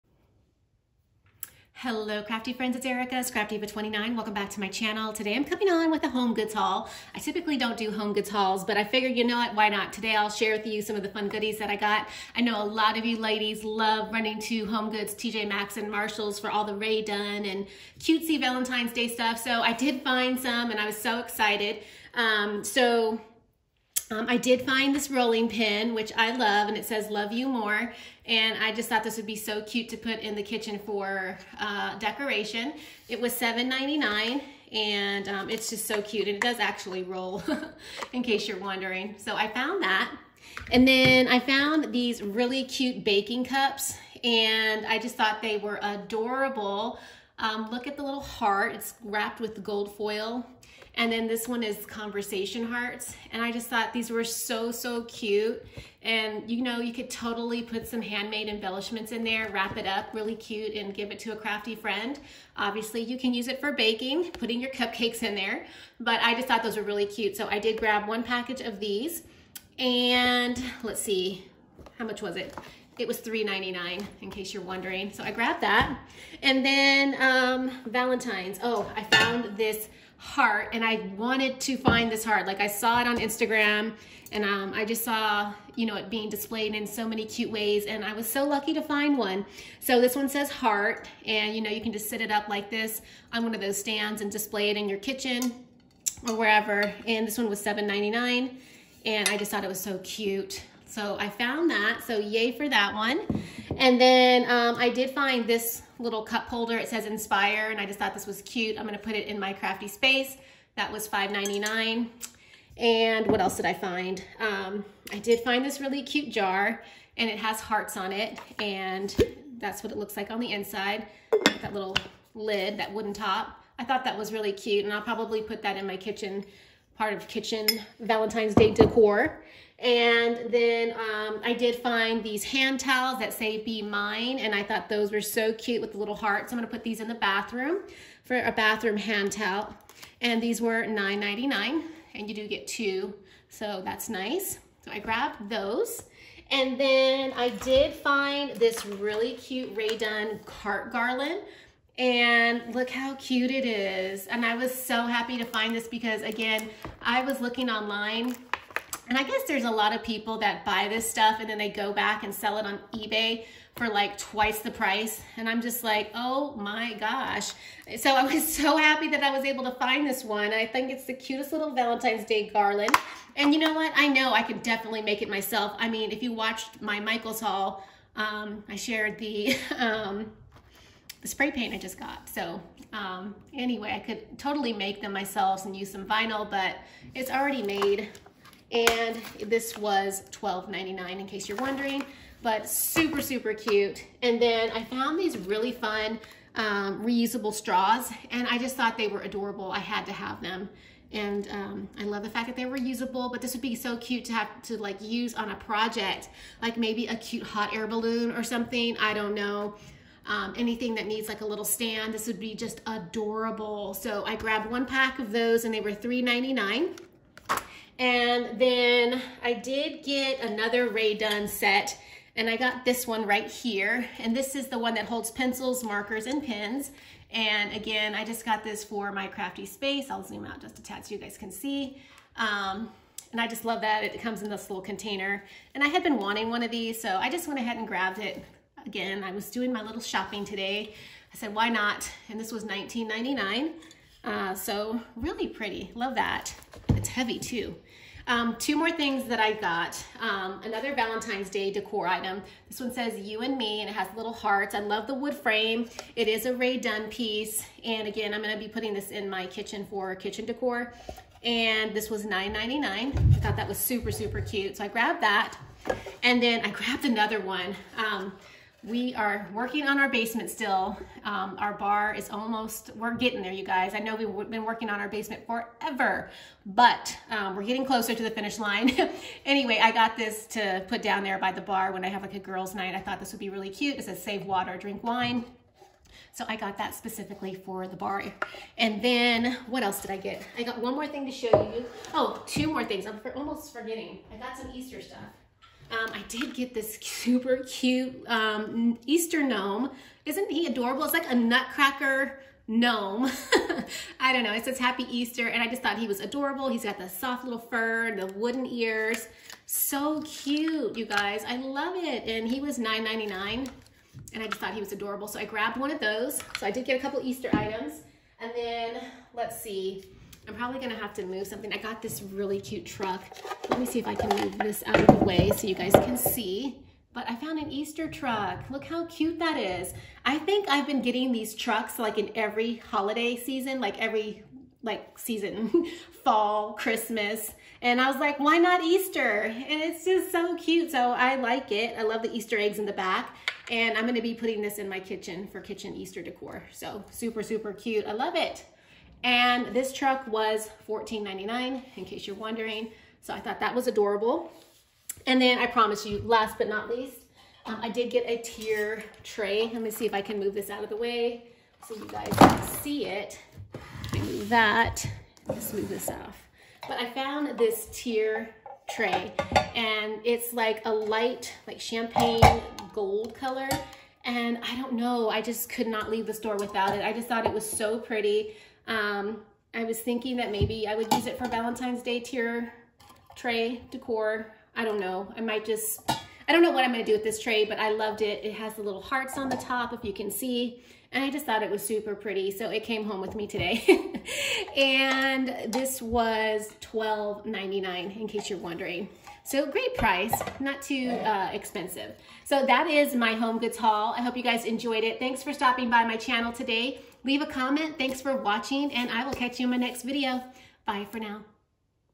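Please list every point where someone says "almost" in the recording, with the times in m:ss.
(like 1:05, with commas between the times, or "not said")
4:32, 4:53.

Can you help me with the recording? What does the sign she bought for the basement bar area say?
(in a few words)
save water, drink wine.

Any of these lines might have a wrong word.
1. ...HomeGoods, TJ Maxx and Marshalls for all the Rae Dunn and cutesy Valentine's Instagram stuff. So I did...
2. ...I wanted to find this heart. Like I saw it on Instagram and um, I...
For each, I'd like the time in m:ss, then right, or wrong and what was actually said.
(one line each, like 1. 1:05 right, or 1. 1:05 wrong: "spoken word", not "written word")
1. 0:14 wrong: "Day", not "Instagram"
2. 1:20 right.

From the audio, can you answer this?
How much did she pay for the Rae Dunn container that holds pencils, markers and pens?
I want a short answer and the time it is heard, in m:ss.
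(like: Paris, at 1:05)
$19.99, at 4:02.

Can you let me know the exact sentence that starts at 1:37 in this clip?
And this one was $7.99 and I just thought it was so cute.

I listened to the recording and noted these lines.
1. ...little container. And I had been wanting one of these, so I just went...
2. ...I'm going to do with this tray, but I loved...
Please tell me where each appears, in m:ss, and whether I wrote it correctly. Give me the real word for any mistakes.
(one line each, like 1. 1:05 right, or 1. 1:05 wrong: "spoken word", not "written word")
1. 3:54 right
2. 6:26 right.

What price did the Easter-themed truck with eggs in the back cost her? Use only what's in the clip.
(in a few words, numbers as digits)
$14.99.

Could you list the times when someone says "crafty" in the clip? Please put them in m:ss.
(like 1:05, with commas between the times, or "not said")
0:02, 1:01, 1:49, 3:49.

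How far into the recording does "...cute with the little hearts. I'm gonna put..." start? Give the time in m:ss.
2:15.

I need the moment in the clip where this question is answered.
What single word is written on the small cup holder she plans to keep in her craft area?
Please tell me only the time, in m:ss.
1:47.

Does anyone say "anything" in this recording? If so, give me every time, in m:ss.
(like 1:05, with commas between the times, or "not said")
3:30.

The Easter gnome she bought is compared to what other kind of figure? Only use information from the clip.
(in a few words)
nutcracker.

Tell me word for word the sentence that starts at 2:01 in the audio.
That little lid, that wooden top.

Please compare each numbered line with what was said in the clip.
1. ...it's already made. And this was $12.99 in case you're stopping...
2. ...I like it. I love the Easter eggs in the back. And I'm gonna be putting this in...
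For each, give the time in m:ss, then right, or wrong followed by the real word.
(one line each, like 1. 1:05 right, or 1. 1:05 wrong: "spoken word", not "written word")
1. 3:07 wrong: "wondering", not "stopping"
2. 5:41 right.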